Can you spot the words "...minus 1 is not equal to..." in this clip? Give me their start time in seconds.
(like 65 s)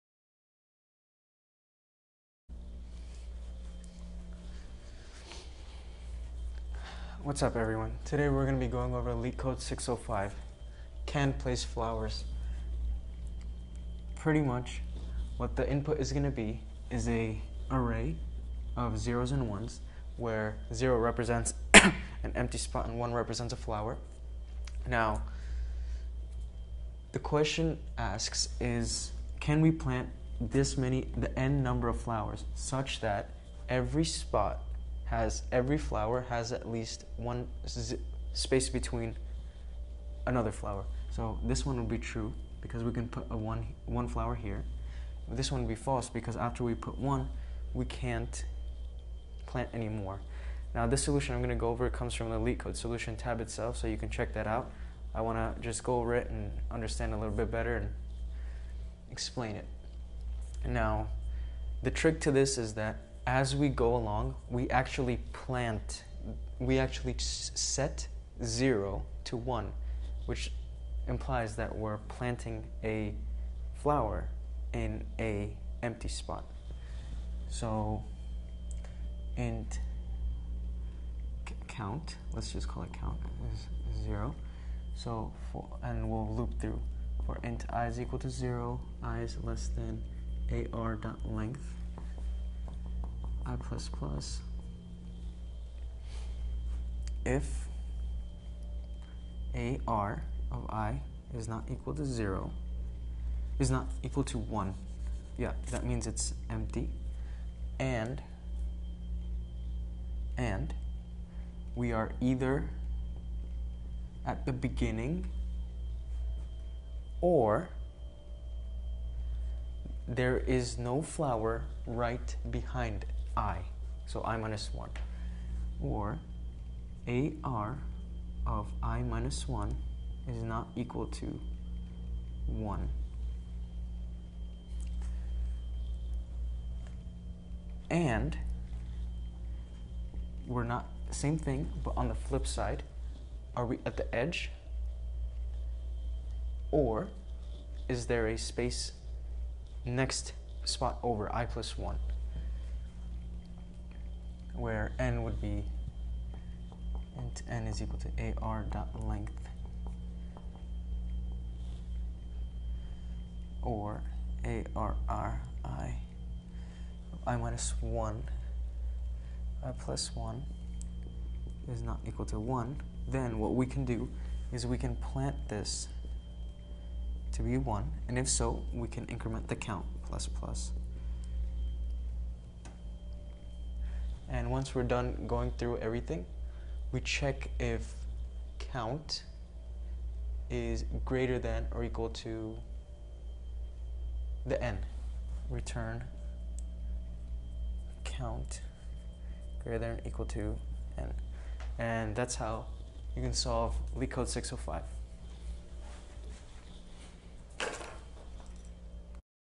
129 s.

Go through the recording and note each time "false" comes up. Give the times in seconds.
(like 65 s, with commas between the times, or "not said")
45 s.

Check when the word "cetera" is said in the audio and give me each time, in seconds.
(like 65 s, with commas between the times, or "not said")
not said.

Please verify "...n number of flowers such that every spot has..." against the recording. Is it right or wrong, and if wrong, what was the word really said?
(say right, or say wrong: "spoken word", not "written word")
right.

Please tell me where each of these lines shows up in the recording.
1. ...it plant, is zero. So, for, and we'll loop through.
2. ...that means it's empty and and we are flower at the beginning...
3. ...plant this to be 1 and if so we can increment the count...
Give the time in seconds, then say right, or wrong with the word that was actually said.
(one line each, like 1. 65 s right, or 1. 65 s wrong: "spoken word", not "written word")
1. 82 s wrong: "count", not "plant"
2. 105 s wrong: "either", not "flower"
3. 175 s right.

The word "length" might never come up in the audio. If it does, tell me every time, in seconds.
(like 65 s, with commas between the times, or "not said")
91 s, 159 s.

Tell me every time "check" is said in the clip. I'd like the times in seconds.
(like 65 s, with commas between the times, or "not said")
54 s, 187 s.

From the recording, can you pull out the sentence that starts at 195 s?
Return count greater than or equal to n.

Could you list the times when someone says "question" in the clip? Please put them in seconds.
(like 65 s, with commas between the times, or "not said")
27 s.